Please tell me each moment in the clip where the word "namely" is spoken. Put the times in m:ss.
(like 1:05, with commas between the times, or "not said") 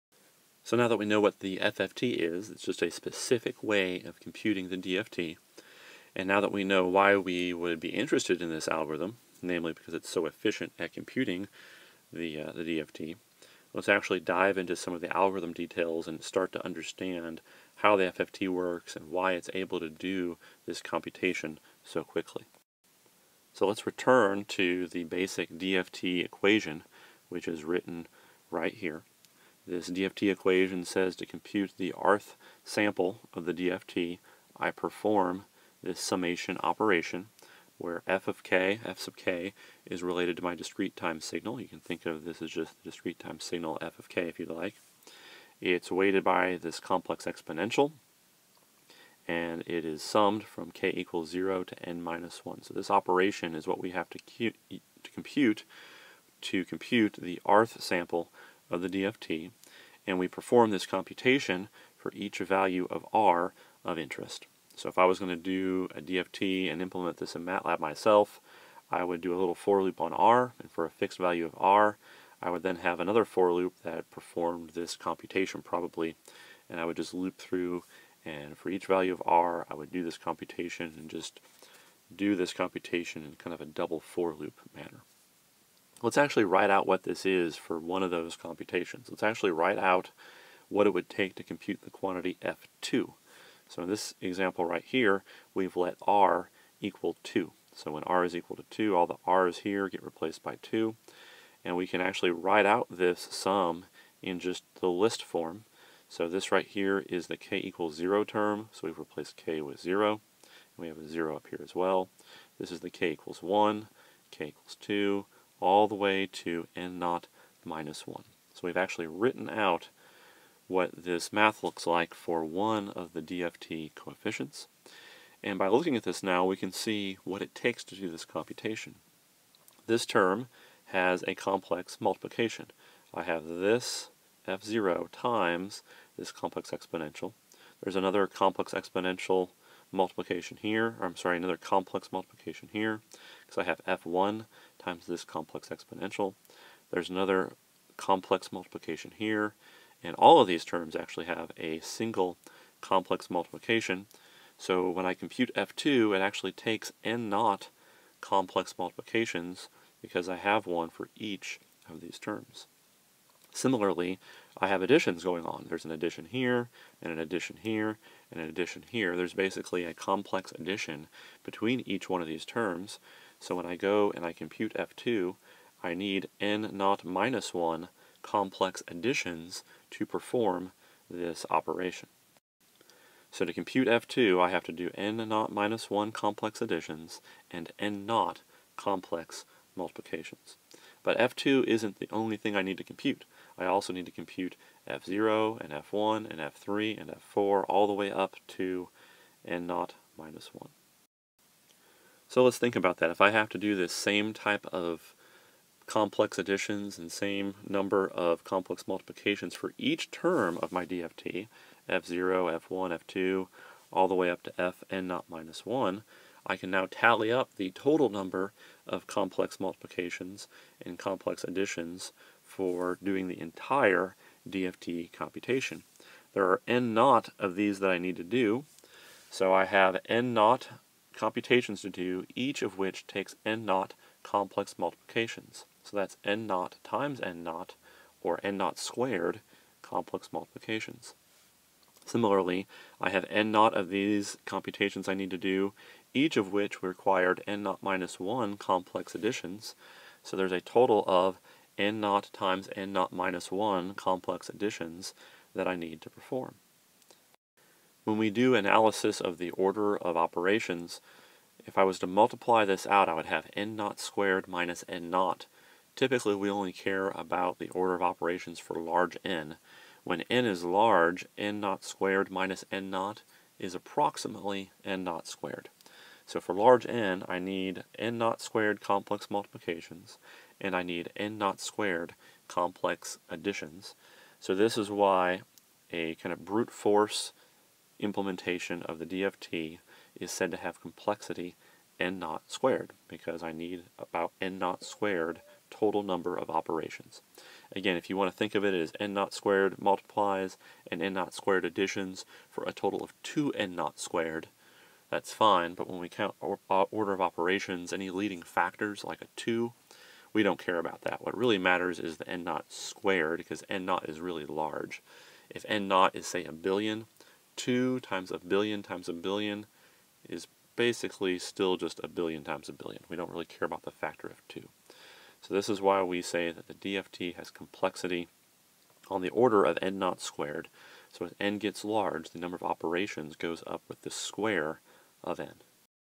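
0:09.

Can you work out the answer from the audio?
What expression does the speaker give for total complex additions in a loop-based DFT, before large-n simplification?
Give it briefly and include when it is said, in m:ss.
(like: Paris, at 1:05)
n naught times n naught minus 1, at 4:11.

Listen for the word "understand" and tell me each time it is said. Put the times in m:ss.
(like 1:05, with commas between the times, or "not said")
0:16.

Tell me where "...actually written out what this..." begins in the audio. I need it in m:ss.
1:58.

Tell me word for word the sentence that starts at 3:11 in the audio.
But F2 isn't the only thing I need to compute.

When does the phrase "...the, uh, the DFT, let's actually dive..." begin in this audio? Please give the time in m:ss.
0:12.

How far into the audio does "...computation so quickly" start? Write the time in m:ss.
0:20.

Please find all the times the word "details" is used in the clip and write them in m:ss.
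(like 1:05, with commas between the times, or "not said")
0:15.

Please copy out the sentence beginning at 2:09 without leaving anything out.
This term has a complex multiplication.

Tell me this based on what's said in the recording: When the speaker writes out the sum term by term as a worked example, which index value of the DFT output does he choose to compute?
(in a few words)
2.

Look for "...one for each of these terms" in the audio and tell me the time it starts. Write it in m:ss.
2:40.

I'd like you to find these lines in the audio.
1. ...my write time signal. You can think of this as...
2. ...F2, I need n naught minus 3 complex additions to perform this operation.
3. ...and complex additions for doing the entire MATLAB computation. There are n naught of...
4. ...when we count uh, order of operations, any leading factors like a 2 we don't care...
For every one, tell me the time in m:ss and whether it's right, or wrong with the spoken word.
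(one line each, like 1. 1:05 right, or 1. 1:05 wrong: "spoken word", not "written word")
1. 0:40 wrong: "discrete", not "write"
2. 2:54 wrong: "1", not "3"
3. 3:40 wrong: "DFT", not "MATLAB"
4. 5:05 right.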